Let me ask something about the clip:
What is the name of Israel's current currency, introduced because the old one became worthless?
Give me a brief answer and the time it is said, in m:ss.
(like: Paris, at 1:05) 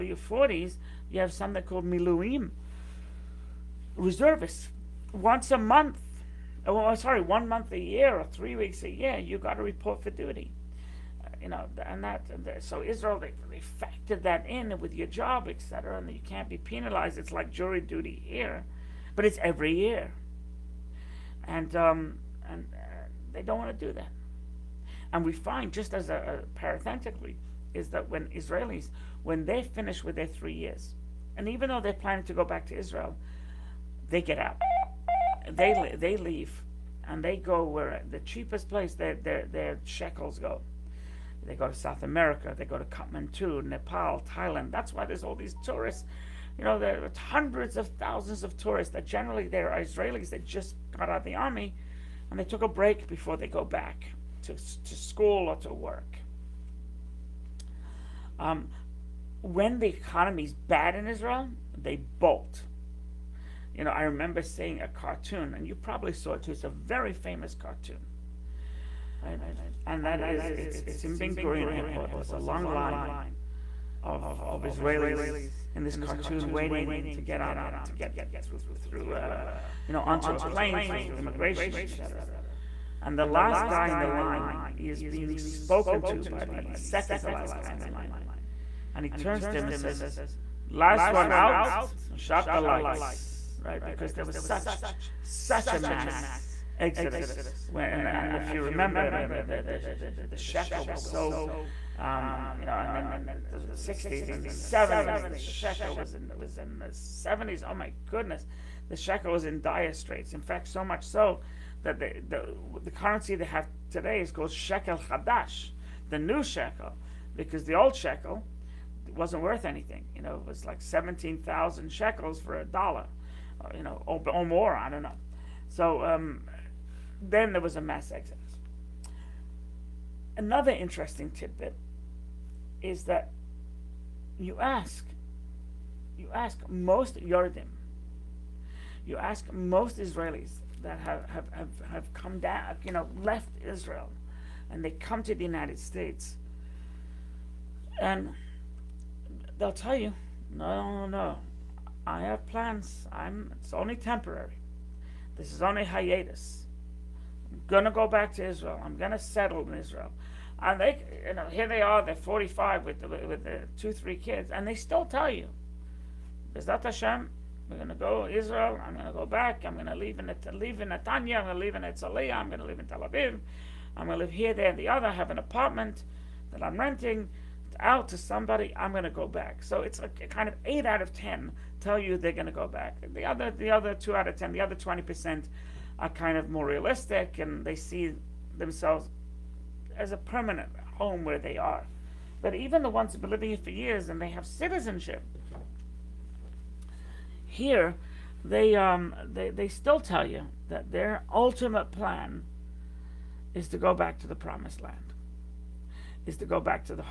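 shekel chadash, at 1:54.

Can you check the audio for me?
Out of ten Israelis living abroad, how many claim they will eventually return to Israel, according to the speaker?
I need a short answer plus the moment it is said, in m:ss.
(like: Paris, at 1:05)
8, at 3:00.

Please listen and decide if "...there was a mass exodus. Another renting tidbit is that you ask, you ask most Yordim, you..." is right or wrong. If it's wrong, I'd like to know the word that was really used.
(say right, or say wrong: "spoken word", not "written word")
wrong: "interesting", not "renting".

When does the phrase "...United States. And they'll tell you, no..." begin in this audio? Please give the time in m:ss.
2:25.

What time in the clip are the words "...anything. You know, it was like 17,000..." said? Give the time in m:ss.
1:59.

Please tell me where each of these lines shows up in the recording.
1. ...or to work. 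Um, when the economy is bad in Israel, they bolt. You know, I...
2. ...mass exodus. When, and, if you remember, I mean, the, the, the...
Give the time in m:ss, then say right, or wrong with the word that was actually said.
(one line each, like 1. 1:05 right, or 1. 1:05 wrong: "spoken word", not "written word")
1. 0:55 right
2. 1:35 right.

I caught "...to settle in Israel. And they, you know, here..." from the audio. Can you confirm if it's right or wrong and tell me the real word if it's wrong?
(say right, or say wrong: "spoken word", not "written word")
right.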